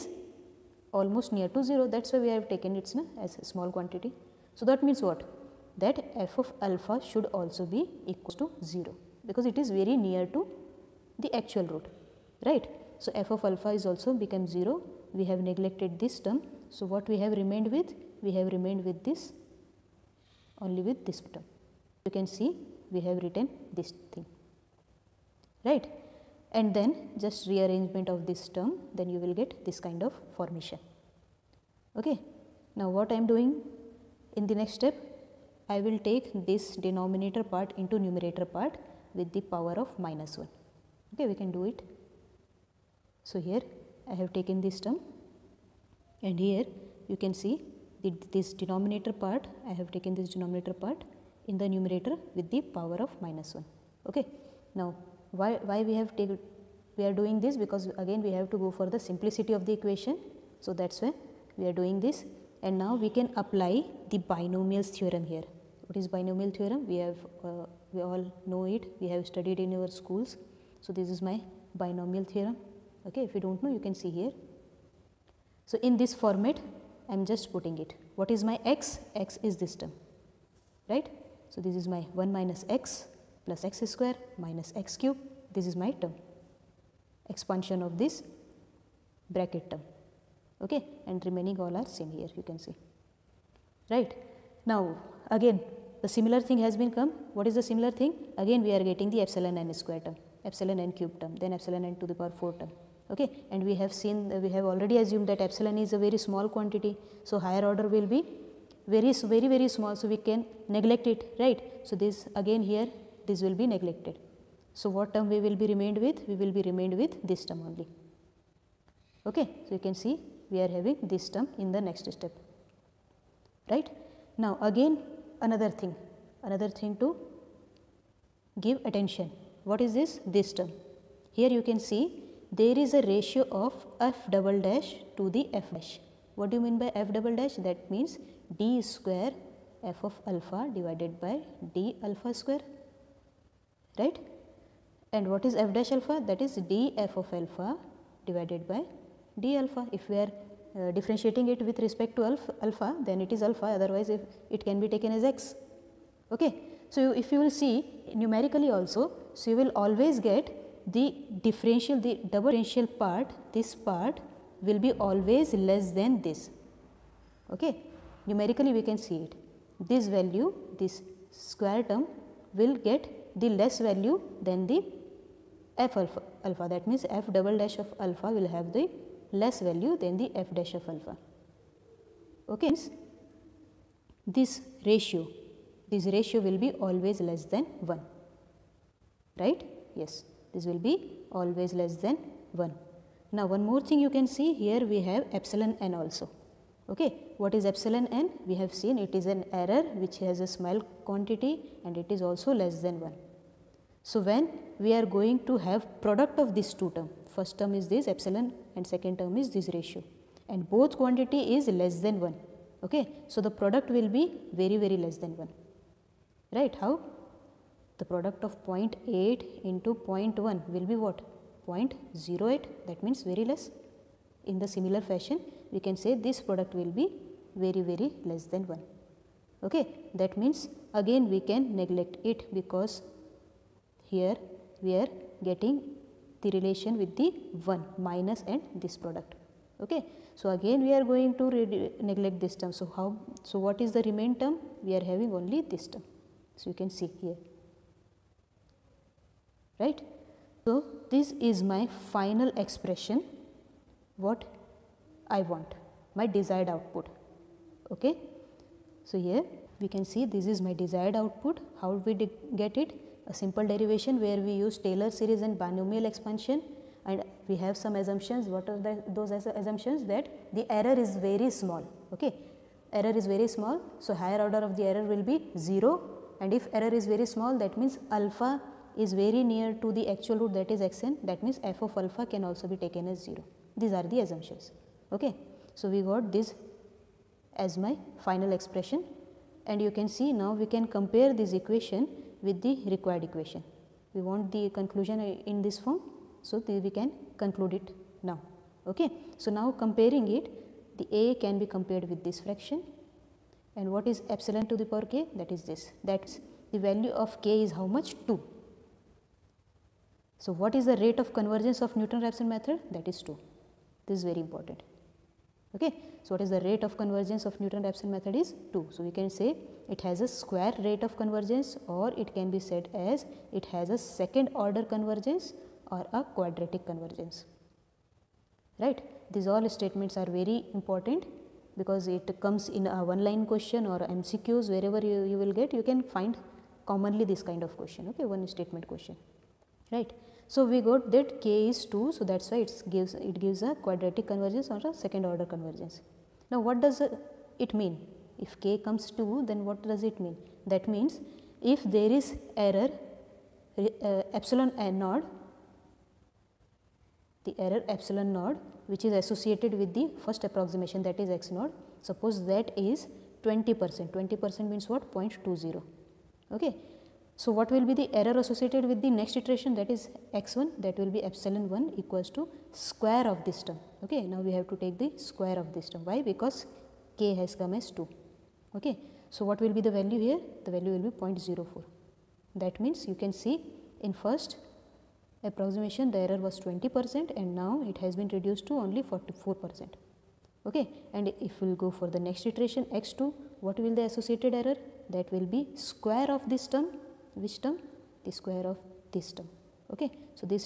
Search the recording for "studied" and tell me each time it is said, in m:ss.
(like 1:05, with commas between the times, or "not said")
1:09.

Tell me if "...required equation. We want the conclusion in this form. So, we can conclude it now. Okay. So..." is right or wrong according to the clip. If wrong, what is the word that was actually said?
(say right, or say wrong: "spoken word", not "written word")
right.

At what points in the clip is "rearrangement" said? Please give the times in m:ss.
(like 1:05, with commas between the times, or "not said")
0:27.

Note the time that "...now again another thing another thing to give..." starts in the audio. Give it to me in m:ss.
2:04.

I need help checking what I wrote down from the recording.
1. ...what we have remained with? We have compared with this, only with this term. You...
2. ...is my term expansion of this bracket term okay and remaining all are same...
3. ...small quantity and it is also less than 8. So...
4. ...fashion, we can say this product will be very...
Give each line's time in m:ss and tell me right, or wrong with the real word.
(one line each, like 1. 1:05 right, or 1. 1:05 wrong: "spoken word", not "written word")
1. 0:16 wrong: "remained", not "compared"
2. 1:25 right
3. 3:20 wrong: "1", not "8"
4. 3:45 right.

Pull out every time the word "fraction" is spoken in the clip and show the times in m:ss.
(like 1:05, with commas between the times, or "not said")
5:02.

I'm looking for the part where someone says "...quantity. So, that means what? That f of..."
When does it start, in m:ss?
0:03.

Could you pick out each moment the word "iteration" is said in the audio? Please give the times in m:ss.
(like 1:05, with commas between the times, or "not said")
6:09, 6:32.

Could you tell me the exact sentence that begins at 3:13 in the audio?
Now, one more thing you can see here we have epsilon n also.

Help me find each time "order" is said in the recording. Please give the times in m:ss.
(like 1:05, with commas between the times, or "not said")
1:47, 4:34, 5:24, 5:45.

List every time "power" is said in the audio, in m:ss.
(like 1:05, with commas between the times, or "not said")
0:39, 0:52, 1:42, 5:04.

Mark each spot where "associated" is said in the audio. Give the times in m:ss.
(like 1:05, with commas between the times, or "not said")
5:59, 6:08, 6:34.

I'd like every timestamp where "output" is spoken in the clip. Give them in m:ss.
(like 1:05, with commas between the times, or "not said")
4:16, 4:21.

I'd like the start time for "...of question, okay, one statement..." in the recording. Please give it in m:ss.
5:37.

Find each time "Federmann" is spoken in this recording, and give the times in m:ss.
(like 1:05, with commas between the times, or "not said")
not said.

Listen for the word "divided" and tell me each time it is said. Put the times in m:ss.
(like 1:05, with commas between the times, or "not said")
2:20, 2:28.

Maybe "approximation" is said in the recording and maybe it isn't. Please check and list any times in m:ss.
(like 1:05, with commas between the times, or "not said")
6:00, 6:25.